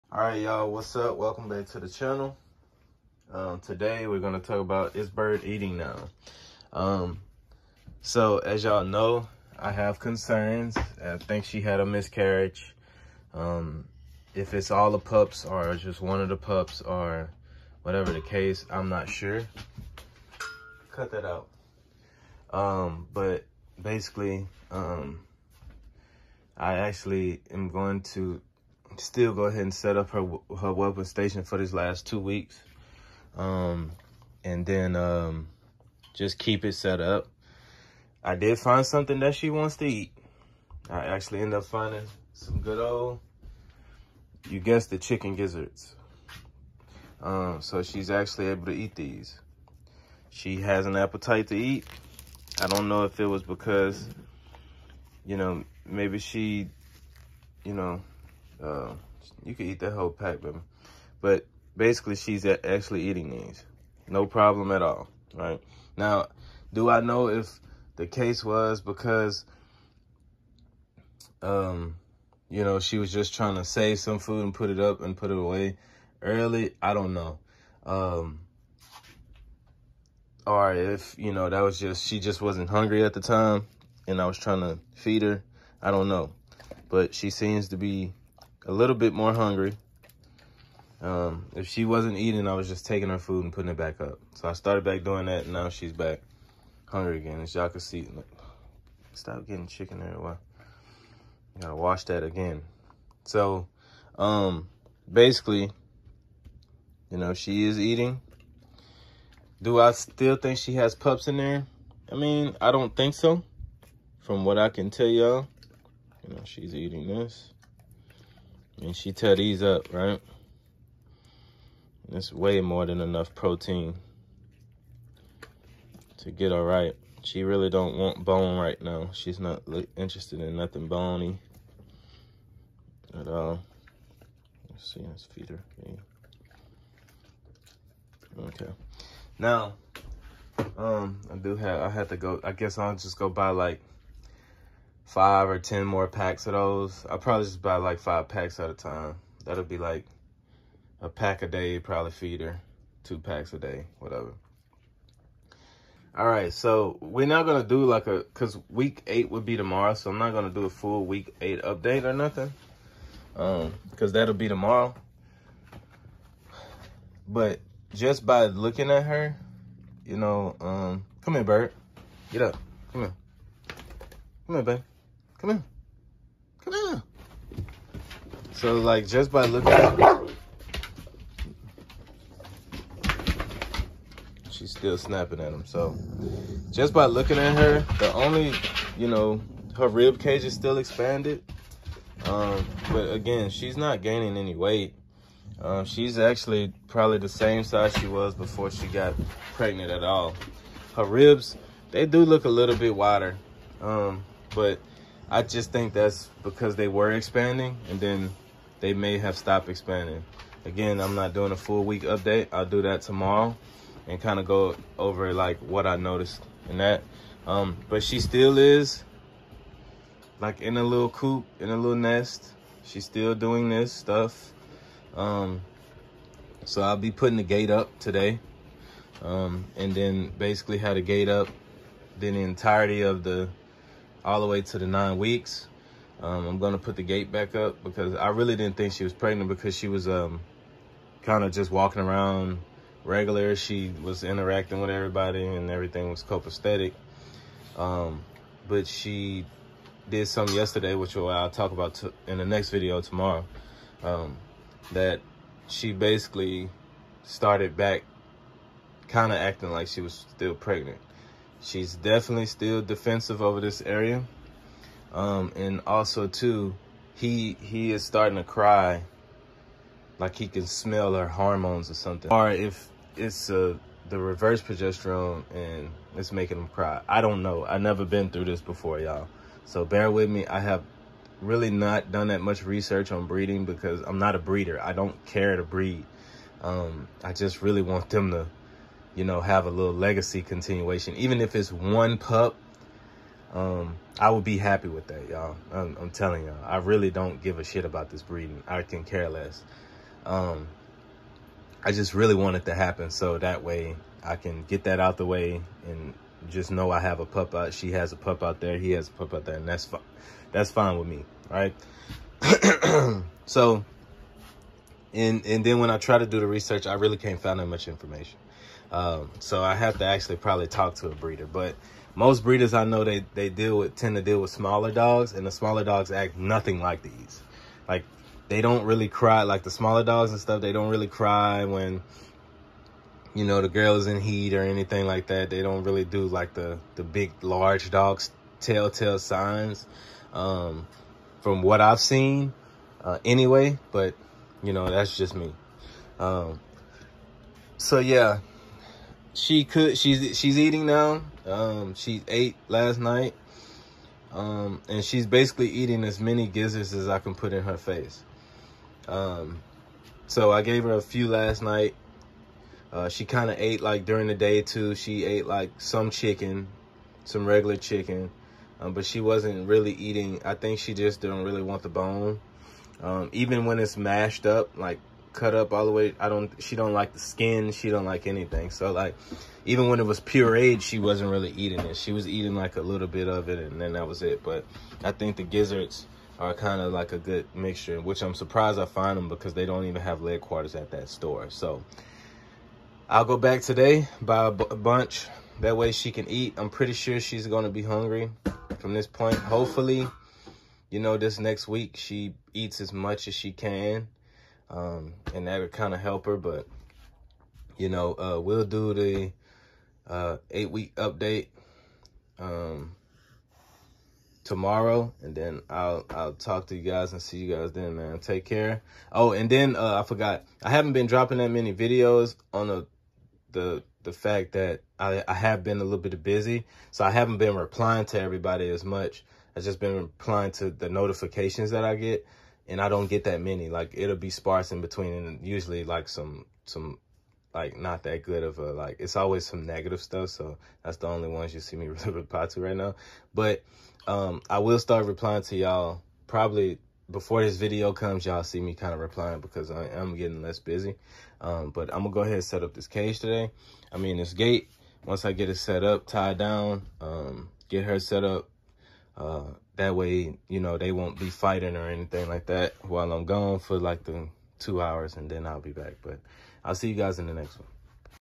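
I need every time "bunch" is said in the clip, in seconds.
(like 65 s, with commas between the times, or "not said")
394 s.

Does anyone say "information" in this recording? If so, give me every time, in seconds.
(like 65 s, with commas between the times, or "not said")
317 s.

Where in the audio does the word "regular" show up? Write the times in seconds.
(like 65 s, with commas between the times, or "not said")
243 s, 367 s.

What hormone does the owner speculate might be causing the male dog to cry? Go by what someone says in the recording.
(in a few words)
Progesterone.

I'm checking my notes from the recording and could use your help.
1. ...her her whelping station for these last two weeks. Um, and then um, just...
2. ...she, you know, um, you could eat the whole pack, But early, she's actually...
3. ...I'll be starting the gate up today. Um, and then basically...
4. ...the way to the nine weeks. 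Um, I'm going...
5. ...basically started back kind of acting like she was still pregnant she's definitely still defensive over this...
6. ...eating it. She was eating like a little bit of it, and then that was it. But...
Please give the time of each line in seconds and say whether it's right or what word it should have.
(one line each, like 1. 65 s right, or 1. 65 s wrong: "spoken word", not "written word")
1. 30 s right
2. 56 s wrong: "basically", not "early"
3. 226 s wrong: "putting", not "starting"
4. 234 s right
5. 255 s right
6. 381 s right.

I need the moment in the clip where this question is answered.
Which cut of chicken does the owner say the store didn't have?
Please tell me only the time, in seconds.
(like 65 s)
390 s.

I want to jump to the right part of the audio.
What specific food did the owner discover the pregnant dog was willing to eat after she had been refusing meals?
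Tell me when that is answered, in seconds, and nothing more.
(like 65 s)
44 s.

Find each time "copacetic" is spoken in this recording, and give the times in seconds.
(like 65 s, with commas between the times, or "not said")
246 s.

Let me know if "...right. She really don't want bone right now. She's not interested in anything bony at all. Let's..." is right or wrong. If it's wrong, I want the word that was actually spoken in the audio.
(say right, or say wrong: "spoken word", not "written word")
wrong: "nothing", not "anything".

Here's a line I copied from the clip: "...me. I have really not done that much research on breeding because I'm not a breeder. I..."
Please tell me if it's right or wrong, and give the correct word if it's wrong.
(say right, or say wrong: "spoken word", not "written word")
right.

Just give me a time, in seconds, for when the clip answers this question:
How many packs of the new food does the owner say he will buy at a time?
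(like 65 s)
147 s.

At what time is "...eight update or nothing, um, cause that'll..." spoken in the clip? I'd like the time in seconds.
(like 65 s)
161 s.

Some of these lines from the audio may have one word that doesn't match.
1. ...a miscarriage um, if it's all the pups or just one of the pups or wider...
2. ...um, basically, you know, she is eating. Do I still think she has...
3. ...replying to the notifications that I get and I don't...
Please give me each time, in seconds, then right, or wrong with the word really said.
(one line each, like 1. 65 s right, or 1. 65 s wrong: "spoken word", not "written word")
1. 11 s wrong: "whatever", not "wider"
2. 104 s right
3. 429 s right.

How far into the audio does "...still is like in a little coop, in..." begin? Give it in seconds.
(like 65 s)
218 s.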